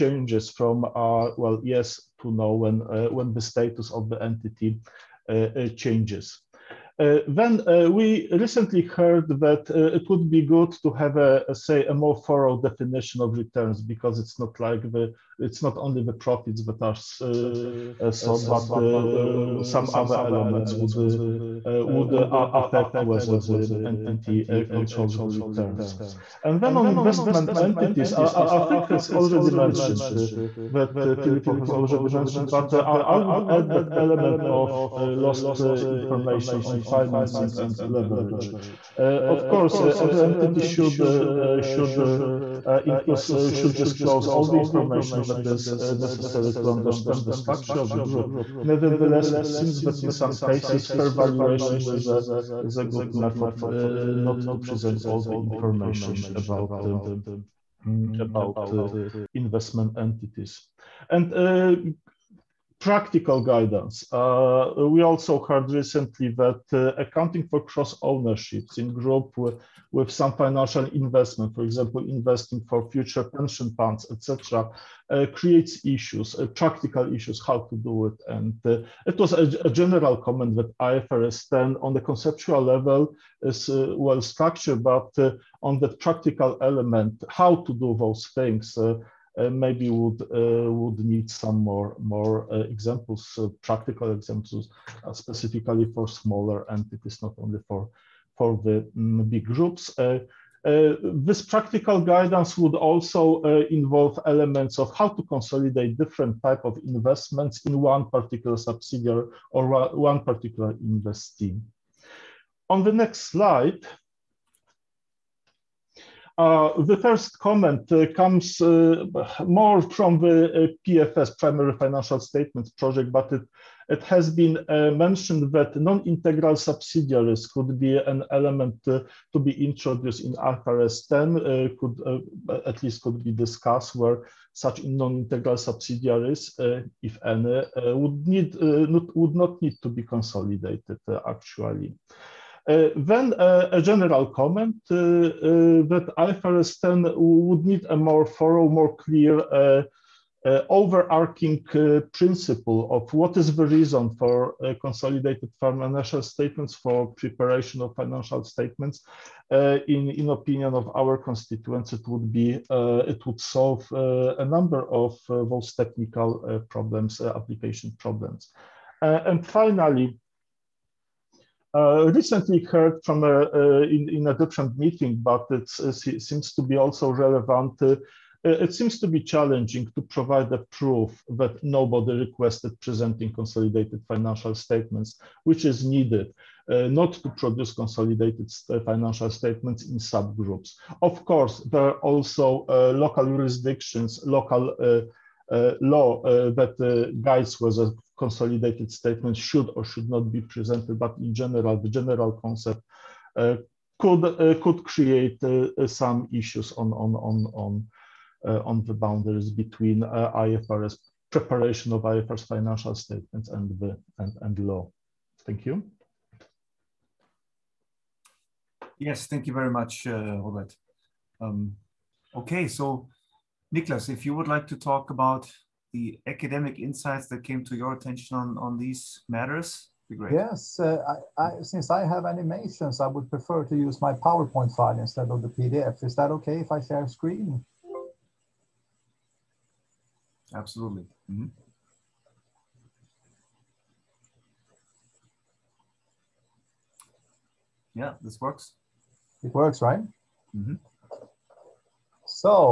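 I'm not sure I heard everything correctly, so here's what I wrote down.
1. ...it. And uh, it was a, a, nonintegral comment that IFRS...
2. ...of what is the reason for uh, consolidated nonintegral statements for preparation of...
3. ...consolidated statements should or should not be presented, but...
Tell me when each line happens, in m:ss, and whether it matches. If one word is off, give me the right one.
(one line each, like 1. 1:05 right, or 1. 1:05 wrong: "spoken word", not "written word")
1. 1:18 wrong: "general", not "nonintegral"
2. 2:32 wrong: "financial", not "nonintegral"
3. 3:18 right.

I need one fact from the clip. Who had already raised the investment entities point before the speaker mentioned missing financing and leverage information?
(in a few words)
Filippo.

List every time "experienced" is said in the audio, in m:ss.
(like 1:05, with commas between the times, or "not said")
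not said.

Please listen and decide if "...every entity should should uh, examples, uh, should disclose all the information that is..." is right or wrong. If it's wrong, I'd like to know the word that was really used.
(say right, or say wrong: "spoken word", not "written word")
wrong: "includes", not "examples".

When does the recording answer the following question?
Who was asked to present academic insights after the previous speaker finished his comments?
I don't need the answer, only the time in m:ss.
3:43.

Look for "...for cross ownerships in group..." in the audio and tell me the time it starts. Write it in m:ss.
1:07.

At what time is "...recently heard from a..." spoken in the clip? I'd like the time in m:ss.
2:52.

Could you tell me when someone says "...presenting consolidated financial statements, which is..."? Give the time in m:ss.
3:02.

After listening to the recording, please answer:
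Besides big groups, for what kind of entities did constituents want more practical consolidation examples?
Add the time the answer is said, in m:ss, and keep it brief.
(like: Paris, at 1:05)
smaller entities, at 1:36.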